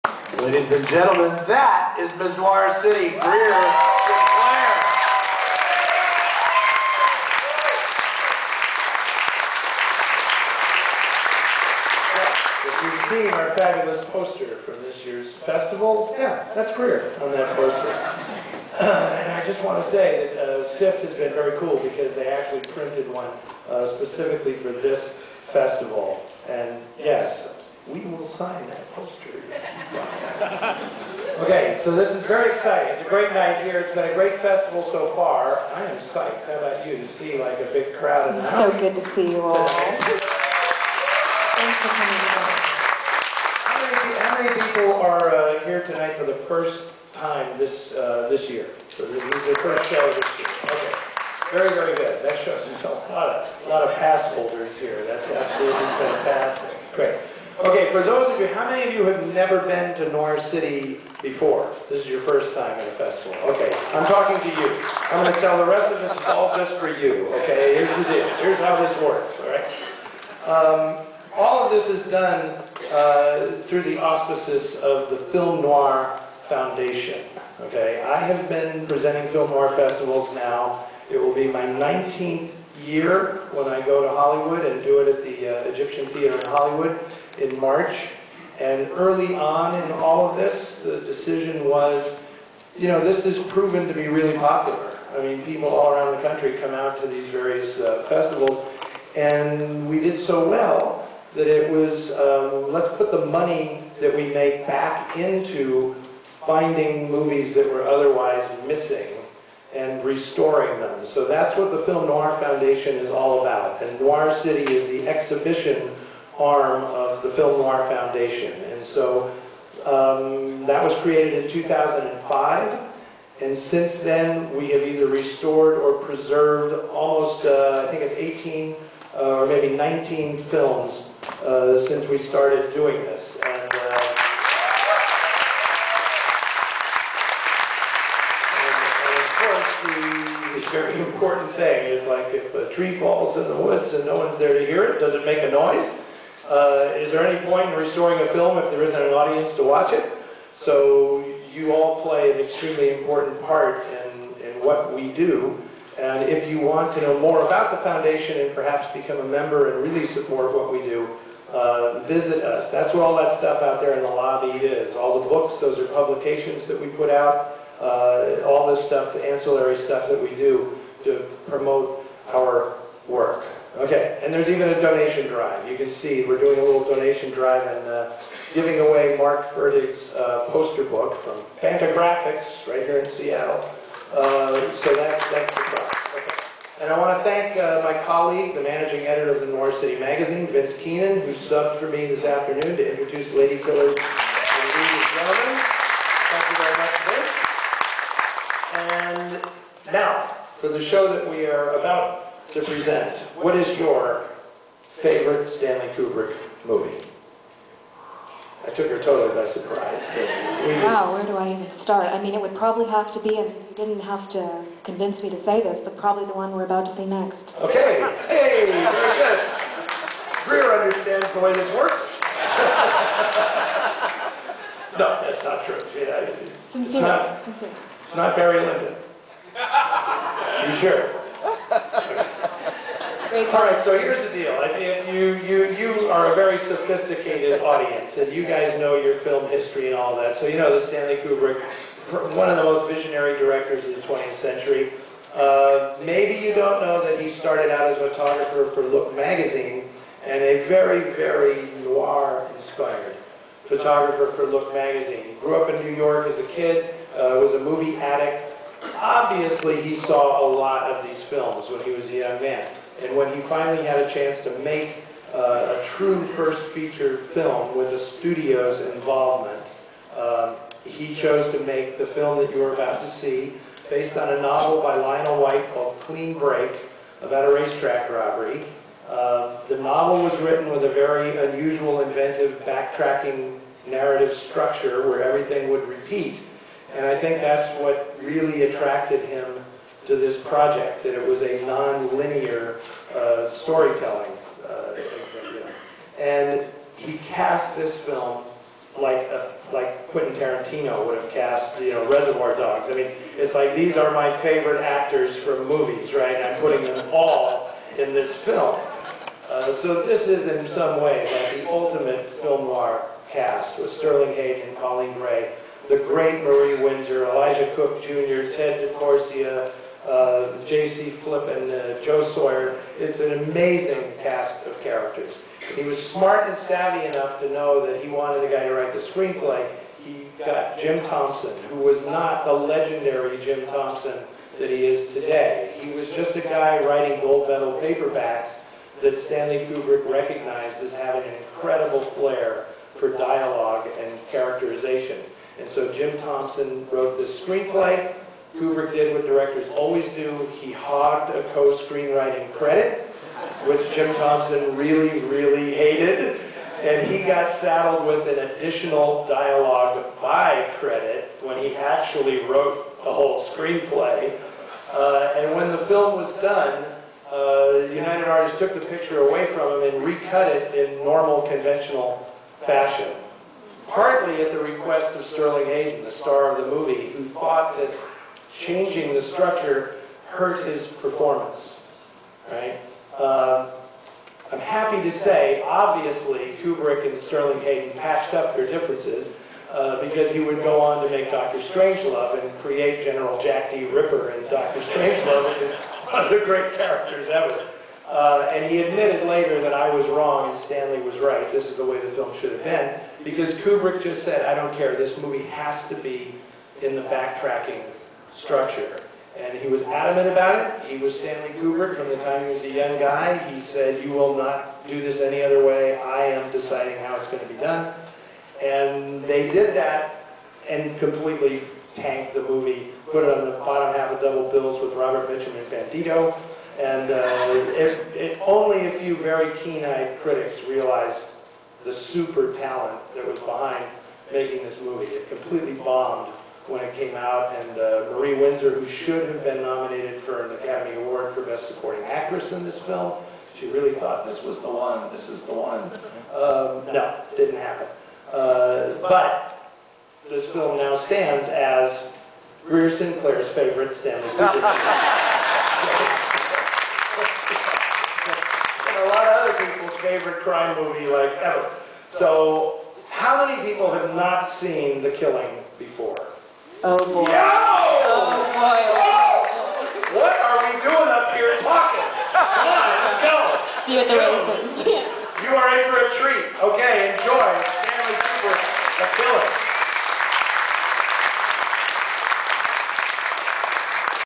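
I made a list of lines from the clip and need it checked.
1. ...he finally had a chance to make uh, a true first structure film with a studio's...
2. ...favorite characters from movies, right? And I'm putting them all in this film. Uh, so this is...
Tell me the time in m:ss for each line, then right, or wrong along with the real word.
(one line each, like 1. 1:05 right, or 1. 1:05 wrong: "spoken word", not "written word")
1. 4:23 wrong: "feature", not "structure"
2. 5:04 wrong: "actors", not "characters".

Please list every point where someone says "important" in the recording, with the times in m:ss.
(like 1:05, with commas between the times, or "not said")
2:21, 2:32.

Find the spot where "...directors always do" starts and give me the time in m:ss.
5:49.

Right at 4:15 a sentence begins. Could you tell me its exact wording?
He grew up in New York as a kid, uh, was a movie addict.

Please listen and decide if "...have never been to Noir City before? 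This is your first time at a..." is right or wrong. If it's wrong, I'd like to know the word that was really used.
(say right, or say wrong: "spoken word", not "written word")
right.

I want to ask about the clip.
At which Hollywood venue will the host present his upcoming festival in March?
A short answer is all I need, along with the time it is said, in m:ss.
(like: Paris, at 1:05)
Egyptian Theater, at 1:25.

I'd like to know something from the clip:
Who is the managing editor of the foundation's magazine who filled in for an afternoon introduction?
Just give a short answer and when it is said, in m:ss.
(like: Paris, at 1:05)
Vince Keenan, at 3:10.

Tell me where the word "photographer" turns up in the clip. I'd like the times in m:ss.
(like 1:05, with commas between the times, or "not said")
4:08, 4:13.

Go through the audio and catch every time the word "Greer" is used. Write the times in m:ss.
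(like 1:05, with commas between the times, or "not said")
0:03, 0:16, 3:40, 7:32.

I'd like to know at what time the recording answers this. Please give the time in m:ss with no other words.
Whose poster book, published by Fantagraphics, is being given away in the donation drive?
2:59.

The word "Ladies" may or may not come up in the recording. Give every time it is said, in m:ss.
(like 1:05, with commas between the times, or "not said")
0:00, 3:14.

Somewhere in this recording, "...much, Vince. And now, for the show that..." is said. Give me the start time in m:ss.
3:19.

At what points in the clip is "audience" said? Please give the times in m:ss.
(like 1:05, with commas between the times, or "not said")
2:29, 3:57.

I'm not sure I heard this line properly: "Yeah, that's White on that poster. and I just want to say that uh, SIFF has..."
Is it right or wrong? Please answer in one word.
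wrong.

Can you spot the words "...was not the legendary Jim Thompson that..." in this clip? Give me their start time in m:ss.
5:31.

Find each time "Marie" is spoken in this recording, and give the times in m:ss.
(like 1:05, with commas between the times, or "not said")
5:16, 7:18.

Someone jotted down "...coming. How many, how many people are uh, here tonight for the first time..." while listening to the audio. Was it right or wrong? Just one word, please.
right.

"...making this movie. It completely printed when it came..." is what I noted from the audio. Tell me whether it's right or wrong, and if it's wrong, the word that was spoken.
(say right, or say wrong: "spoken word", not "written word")
wrong: "bombed", not "printed".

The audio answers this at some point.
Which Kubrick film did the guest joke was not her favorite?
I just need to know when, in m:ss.
3:48.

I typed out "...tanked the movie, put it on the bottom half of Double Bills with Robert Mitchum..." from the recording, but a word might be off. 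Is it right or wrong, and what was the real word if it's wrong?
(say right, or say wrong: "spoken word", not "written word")
right.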